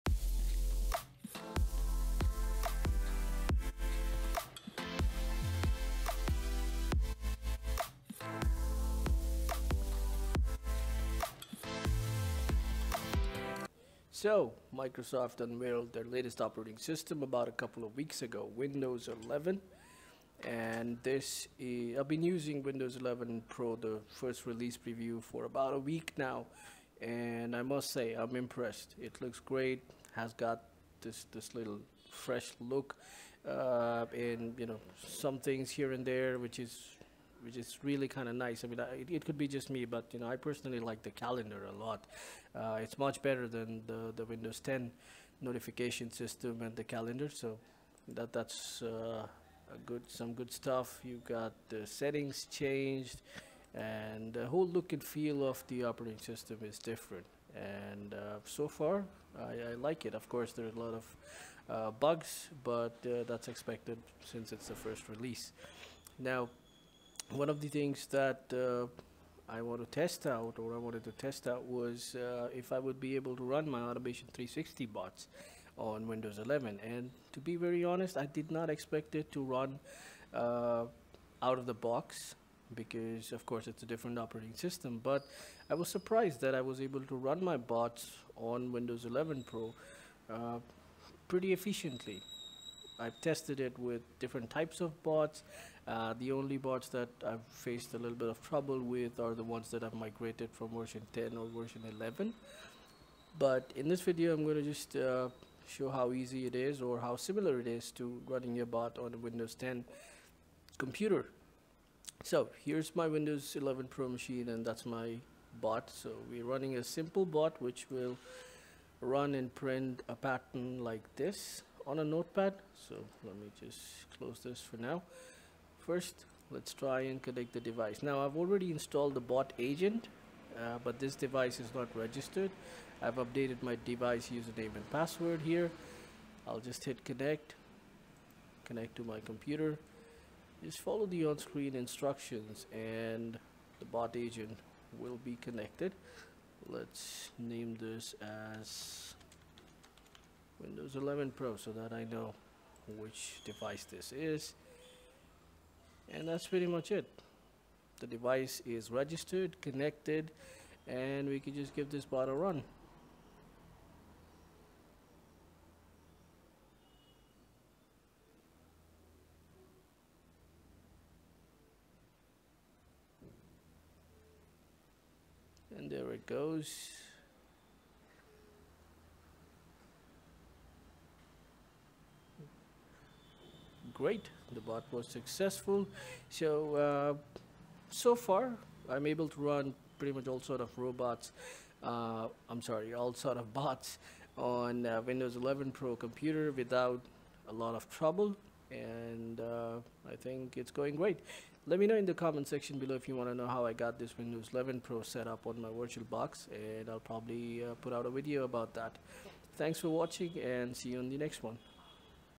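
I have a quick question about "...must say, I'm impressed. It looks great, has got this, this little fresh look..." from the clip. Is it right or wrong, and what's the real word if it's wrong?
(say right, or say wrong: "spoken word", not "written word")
right.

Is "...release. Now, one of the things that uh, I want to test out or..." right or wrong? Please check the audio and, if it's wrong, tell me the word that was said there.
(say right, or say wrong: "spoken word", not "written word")
right.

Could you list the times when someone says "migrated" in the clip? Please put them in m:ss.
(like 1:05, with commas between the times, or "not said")
1:39.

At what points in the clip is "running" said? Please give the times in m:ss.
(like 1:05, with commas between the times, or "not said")
1:48, 1:56.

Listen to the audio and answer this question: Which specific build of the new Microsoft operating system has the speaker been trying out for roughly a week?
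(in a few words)
first release preview.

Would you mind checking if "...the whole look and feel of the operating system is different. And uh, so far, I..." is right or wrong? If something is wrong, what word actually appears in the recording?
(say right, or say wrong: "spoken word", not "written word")
right.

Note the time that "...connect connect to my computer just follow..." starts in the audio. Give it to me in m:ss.
2:17.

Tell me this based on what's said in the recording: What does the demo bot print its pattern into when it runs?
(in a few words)
notepad.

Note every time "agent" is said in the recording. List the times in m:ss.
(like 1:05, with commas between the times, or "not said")
2:09, 2:24.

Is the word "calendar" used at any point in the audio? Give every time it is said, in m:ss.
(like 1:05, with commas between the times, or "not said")
0:41, 0:46.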